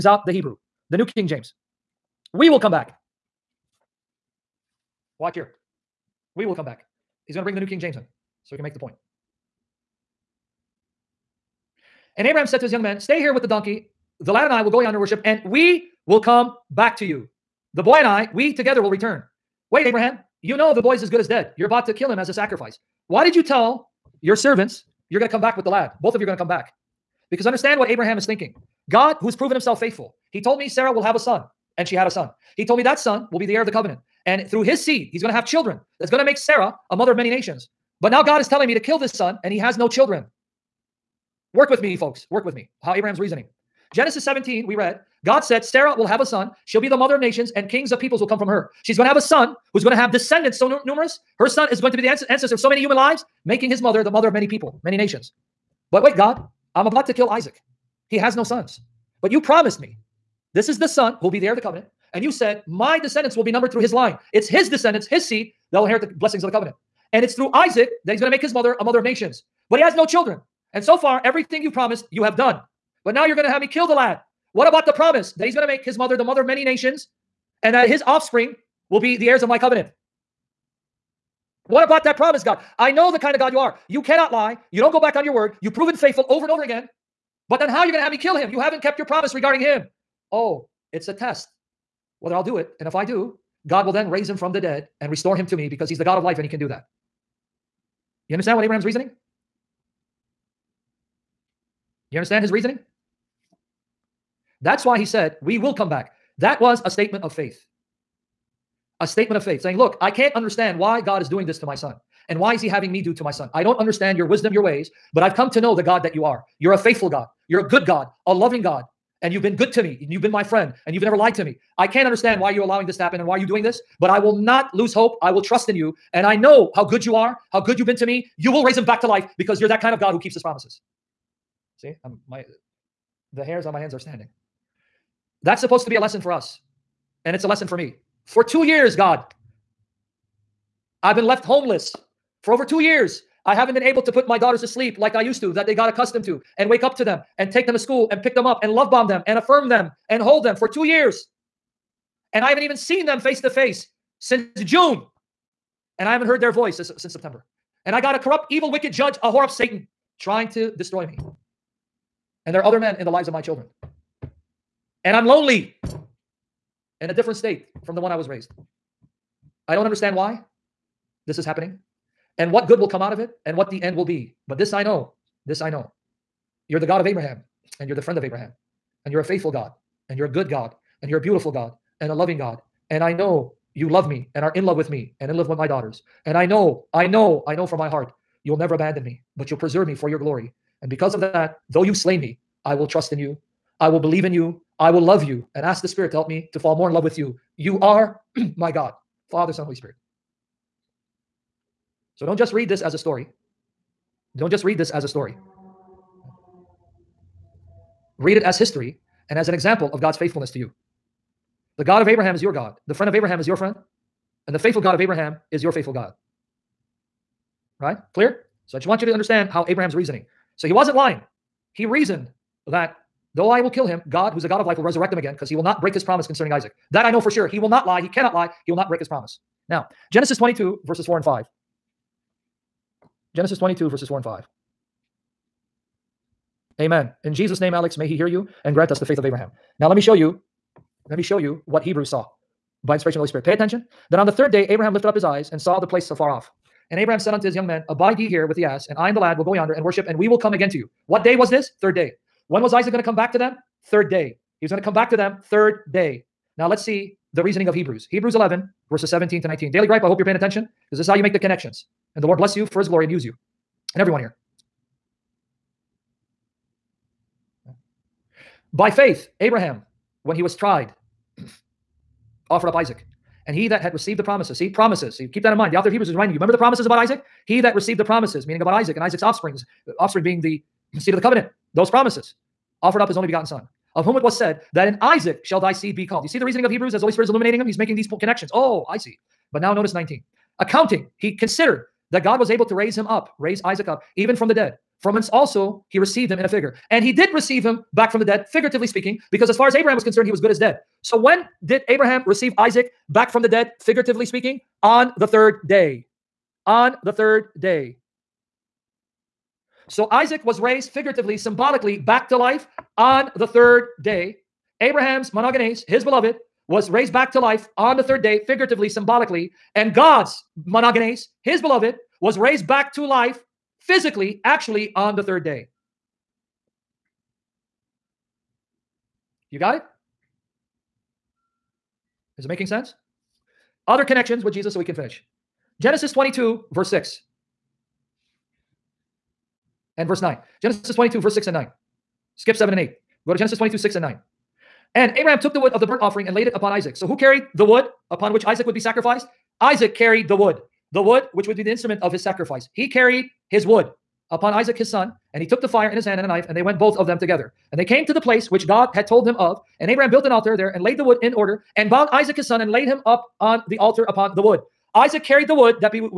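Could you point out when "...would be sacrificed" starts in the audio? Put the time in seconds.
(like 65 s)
348 s.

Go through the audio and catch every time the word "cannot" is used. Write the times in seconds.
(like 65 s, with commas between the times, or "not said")
84 s, 228 s.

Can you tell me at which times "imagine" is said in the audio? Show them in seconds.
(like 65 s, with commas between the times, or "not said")
not said.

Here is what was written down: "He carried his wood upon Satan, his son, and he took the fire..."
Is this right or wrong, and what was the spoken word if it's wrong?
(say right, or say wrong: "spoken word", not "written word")
wrong: "Isaac", not "Satan".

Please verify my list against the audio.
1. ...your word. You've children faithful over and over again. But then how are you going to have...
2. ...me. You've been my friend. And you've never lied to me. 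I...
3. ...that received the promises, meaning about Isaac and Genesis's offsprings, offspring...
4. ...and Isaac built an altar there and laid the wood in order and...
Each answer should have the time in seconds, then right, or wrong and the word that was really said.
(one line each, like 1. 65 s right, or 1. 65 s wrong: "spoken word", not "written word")
1. 85 s wrong: "proven", not "children"
2. 119 s right
3. 277 s wrong: "Isaac", not "Genesis"
4. 359 s wrong: "Abraham", not "Isaac".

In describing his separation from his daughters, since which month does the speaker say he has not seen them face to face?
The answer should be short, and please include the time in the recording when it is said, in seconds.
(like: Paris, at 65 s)
June, at 154 s.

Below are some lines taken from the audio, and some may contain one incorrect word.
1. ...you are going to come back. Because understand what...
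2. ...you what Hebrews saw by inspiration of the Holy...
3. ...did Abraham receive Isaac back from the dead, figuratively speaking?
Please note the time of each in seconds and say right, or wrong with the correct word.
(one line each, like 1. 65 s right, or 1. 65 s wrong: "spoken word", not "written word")
1. 26 s right
2. 241 s right
3. 301 s right.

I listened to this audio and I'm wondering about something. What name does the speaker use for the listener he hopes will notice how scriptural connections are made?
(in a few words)
Daily Gripe.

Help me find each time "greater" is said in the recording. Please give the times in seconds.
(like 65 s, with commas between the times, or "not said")
not said.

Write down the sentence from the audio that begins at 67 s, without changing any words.
And it's through Isaac that he's going to make his mother a mother of nations.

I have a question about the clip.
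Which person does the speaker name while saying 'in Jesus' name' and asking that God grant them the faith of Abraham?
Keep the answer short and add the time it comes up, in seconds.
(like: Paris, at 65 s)
Alex, at 237 s.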